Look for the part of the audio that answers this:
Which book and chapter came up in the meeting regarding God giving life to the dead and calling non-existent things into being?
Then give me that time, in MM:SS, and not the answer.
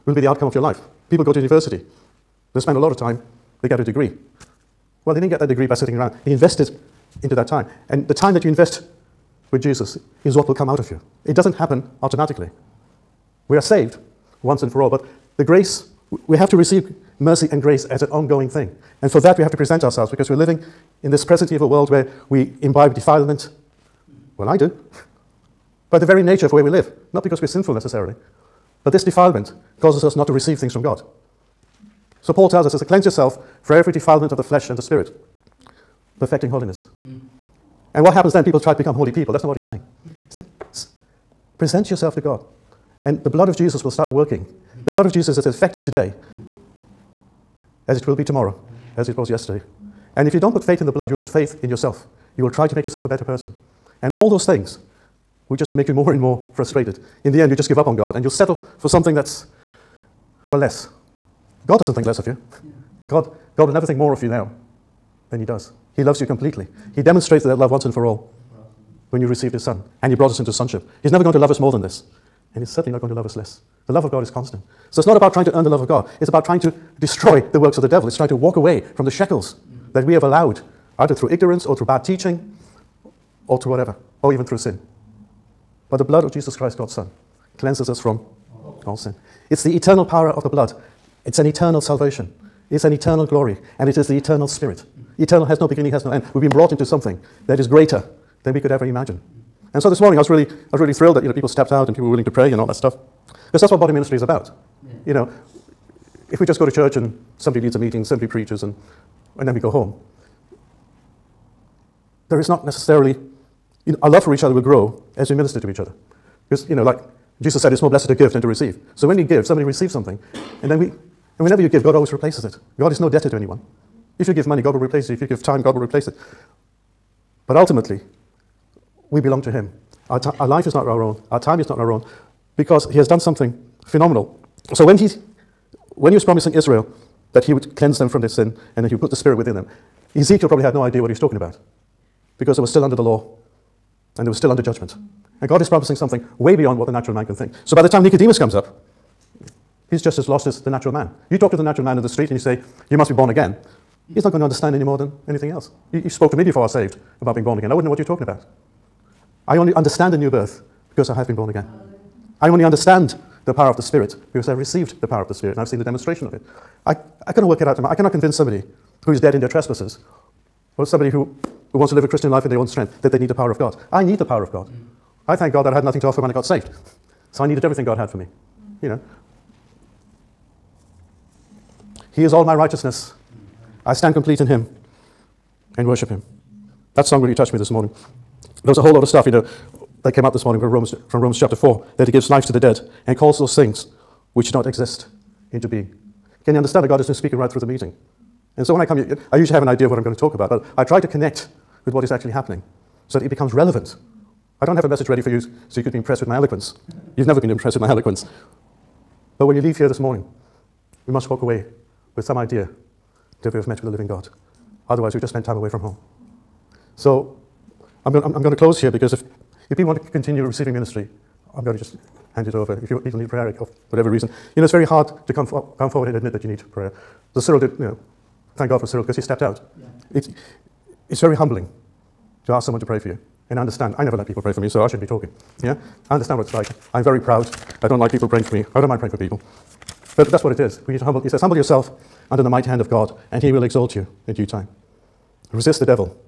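03:11.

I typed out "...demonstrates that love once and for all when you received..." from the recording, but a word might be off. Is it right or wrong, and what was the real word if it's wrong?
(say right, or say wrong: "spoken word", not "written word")
right.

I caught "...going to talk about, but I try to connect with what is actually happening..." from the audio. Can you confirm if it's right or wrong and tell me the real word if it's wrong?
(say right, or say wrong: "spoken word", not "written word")
right.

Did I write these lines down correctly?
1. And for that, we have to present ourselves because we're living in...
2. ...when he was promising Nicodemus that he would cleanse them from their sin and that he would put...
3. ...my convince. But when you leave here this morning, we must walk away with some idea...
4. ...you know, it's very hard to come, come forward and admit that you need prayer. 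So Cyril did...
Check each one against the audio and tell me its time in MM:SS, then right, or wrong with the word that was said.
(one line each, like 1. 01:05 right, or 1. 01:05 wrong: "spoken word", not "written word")
1. 00:19 right
2. 02:15 wrong: "Israel", not "Nicodemus"
3. 03:27 wrong: "eloquence", not "convince"
4. 03:44 right.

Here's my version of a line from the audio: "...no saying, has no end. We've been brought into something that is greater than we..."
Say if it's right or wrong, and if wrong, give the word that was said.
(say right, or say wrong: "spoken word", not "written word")
wrong: "beginning", not "saying".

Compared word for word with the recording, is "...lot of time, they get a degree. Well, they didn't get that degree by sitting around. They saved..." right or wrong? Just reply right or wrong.
wrong.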